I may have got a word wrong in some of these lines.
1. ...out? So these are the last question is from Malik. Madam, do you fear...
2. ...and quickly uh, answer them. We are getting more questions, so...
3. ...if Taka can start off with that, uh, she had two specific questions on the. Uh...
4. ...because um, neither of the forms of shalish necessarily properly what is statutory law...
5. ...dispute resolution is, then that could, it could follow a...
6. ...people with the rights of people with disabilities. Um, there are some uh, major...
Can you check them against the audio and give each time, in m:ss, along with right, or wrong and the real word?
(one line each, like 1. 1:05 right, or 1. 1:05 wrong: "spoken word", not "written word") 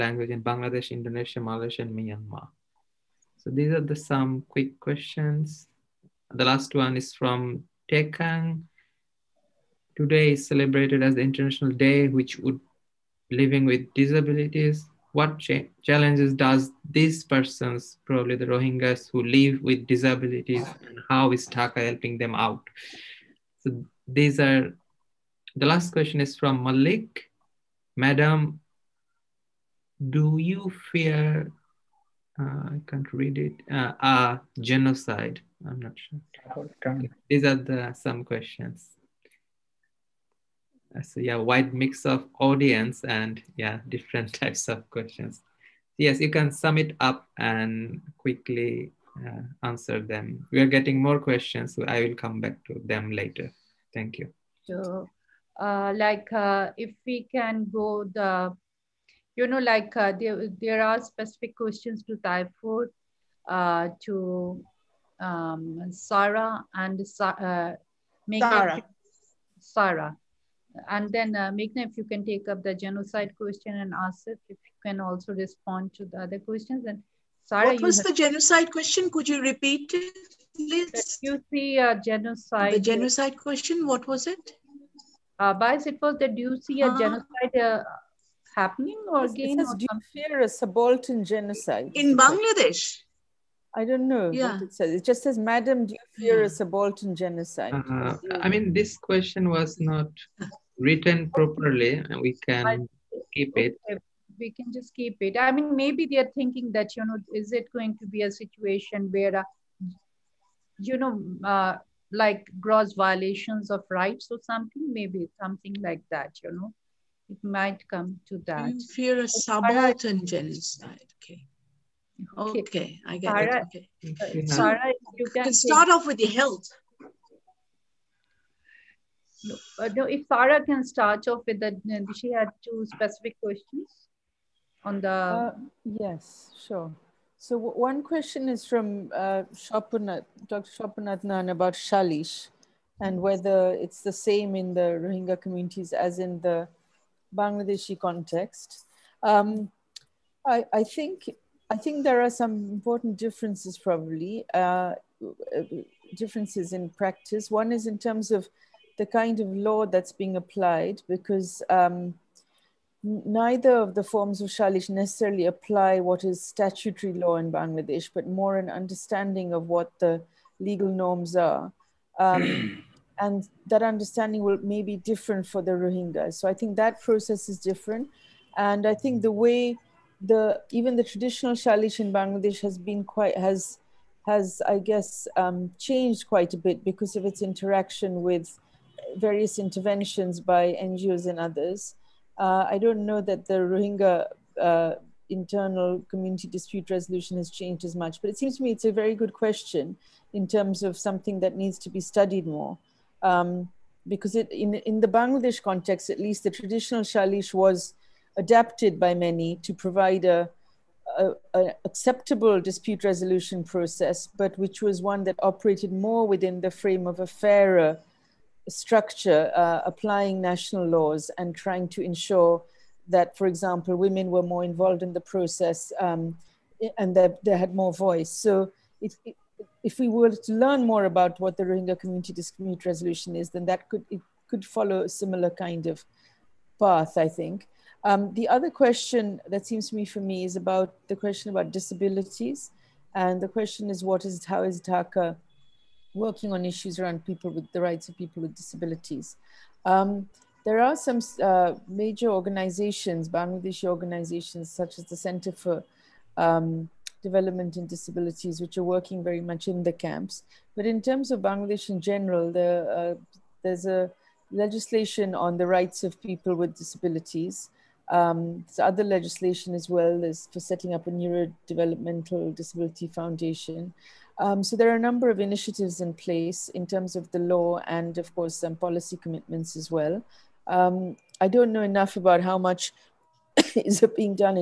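1. 0:22 right
2. 0:47 right
3. 2:10 wrong: "Sarah", not "Taka"
4. 2:41 wrong: "apply", not "properly"
5. 3:52 right
6. 4:07 right.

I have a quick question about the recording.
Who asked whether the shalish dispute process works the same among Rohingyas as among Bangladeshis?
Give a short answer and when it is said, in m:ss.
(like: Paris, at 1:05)
Dr. Shapan Adnan, at 2:19.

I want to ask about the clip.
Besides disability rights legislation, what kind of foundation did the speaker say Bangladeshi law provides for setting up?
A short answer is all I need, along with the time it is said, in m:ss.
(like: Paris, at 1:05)
Neurodevelopmental disability foundation, at 4:31.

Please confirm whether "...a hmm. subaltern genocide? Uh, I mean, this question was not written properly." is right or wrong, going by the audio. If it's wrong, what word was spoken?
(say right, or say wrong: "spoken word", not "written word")
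right.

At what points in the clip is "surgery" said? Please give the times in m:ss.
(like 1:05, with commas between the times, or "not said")
not said.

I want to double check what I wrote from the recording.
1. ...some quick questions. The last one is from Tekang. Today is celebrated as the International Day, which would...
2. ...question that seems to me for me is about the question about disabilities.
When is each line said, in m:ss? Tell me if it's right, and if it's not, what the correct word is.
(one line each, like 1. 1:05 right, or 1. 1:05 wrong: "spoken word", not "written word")
1. 0:03 right
2. 3:58 right.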